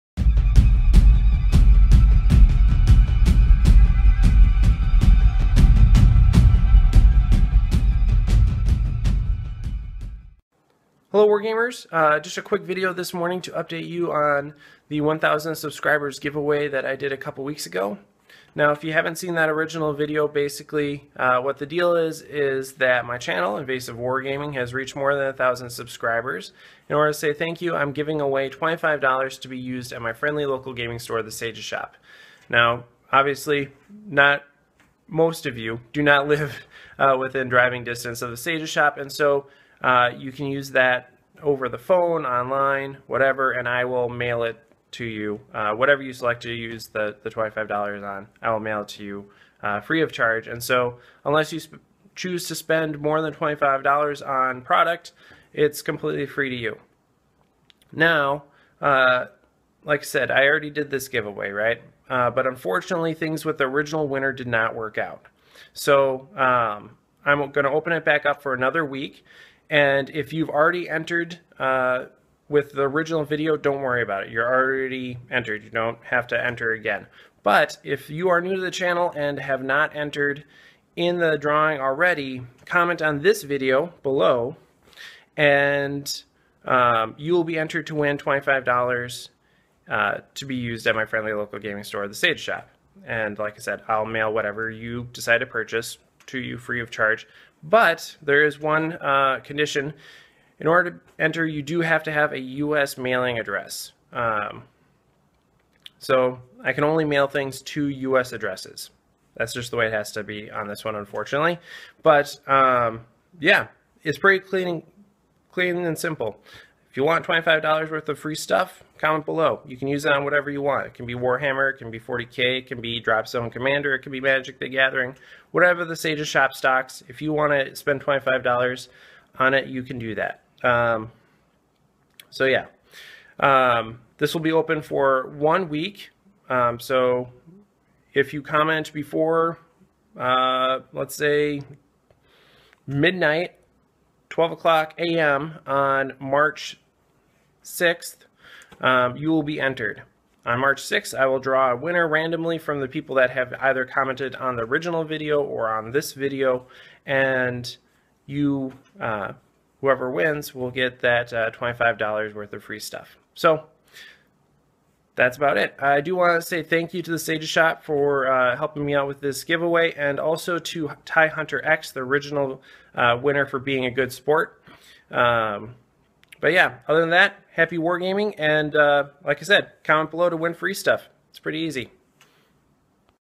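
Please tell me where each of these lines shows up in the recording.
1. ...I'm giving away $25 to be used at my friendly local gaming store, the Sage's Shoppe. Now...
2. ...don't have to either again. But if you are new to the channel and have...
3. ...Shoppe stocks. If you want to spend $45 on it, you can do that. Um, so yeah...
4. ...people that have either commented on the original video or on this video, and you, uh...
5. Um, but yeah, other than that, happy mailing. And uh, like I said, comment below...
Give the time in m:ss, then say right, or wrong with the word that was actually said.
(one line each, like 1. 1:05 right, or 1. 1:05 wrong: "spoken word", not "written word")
1. 0:27 right
2. 1:15 wrong: "enter", not "either"
3. 2:06 wrong: "25", not "45"
4. 2:32 right
5. 2:55 wrong: "wargaming", not "mailing".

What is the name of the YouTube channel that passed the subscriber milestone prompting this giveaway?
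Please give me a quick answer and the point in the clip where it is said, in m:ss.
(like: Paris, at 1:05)
Invasive Wargaming, at 0:23.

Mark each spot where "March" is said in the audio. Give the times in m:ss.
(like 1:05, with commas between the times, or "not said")
2:26, 2:30.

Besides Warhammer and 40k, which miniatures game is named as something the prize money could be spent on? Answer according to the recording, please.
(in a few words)
Dropzone Commander.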